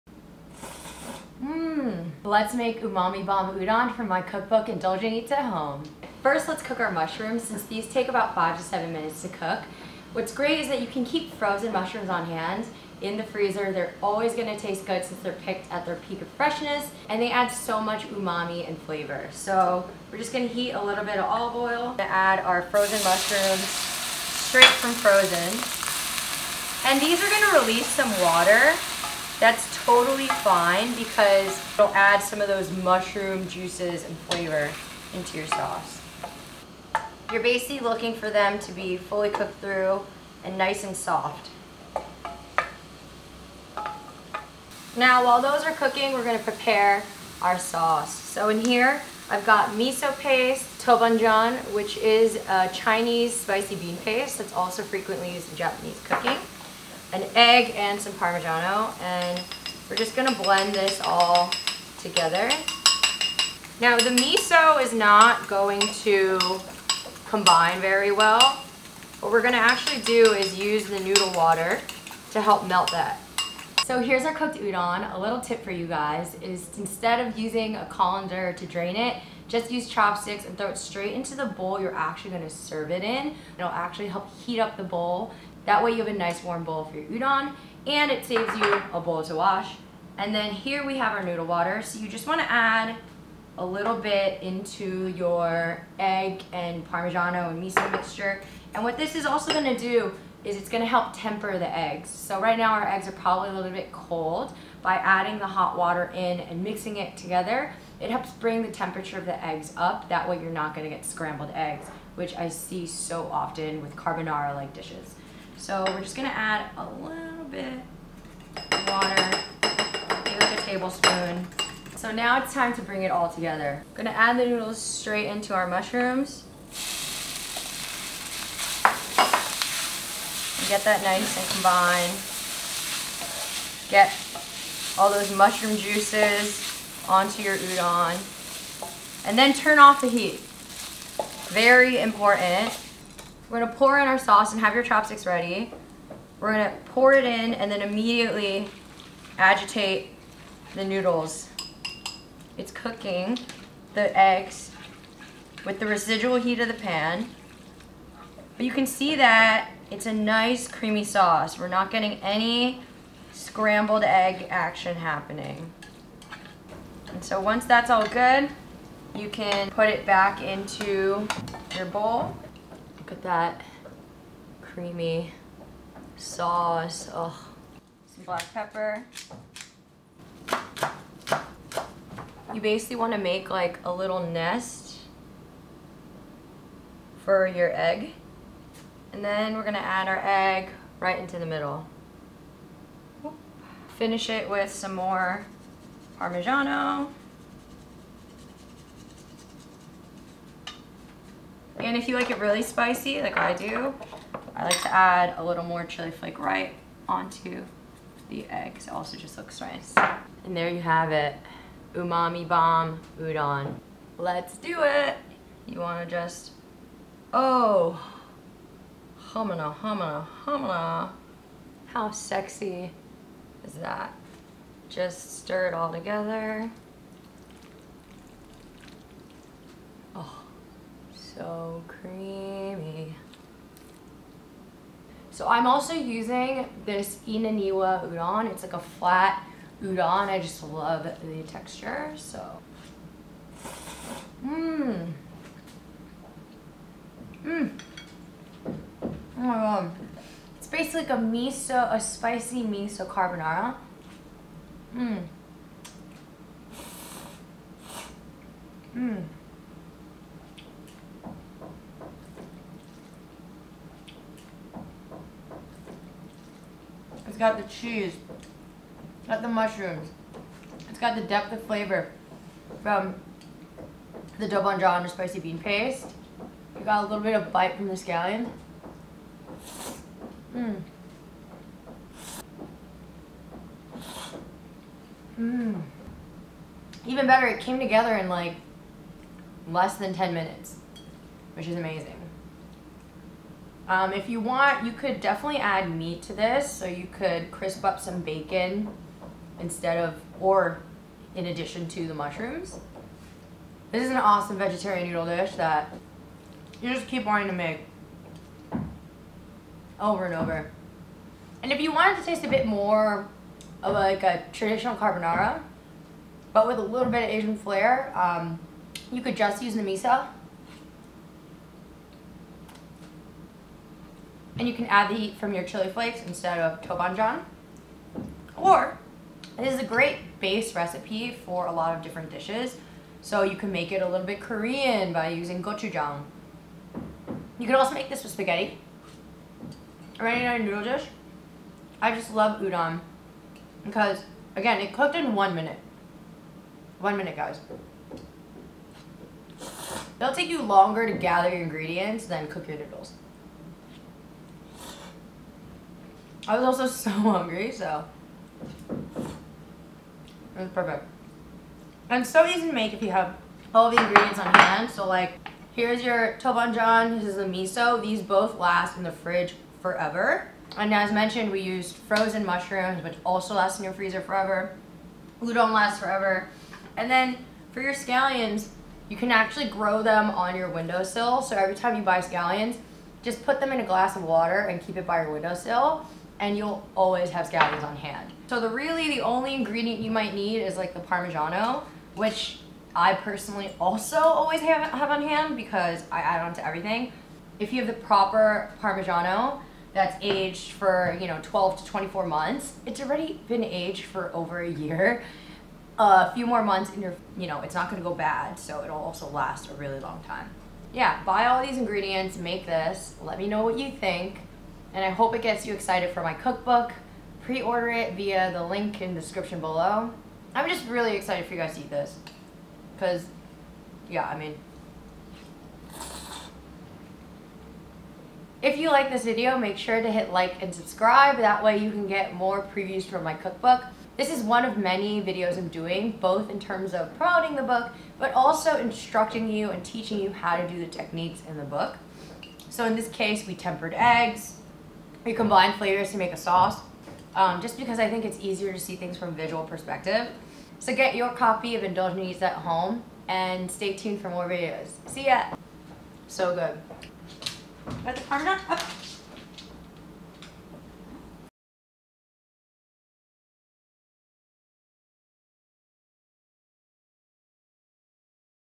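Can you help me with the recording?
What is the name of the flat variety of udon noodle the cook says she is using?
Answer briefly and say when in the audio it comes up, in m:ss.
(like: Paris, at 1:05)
Inaniwa udon, at 3:57.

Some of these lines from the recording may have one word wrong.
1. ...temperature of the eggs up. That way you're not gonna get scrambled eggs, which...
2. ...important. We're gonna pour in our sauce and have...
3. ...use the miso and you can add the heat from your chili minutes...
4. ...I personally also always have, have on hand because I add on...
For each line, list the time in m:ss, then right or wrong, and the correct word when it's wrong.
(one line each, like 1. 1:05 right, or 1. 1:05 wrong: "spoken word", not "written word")
1. 1:48 right
2. 2:22 right
3. 5:19 wrong: "flakes", not "minutes"
4. 6:32 right.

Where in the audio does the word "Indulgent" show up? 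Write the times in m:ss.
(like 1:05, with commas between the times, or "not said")
0:04, 7:31.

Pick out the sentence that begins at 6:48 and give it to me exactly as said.
So it'll also last a really long time.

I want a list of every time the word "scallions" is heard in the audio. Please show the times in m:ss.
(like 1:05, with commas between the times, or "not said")
4:37, 6:17, 6:22, 6:27.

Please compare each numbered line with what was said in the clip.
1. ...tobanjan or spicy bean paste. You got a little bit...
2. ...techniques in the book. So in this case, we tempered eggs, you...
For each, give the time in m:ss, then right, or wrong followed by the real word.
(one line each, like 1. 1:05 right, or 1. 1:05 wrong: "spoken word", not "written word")
1. 4:34 right
2. 7:20 right.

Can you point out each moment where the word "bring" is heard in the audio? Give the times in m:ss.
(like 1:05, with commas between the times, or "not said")
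1:48, 2:02.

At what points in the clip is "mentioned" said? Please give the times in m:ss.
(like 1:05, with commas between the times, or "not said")
6:11.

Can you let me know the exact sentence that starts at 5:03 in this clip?
This is an awesome vegetarian noodle dish that you just keep wanting to make over and over.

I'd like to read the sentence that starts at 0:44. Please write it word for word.
Now while those are cooking, we're gonna prepare our sauce.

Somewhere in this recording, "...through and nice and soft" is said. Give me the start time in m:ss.
0:39.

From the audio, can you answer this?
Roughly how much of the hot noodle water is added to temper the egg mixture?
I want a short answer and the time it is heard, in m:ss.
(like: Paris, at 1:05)
a tablespoon, at 2:00.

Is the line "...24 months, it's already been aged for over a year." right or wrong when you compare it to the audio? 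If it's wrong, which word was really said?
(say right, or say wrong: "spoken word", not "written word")
right.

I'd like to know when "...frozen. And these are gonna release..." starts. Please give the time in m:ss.
0:24.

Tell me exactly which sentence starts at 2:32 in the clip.
It's cooking the eggs with the residual heat of the pan.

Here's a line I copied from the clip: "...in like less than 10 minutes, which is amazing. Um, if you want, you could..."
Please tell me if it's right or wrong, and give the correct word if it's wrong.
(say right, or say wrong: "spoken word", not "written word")
right.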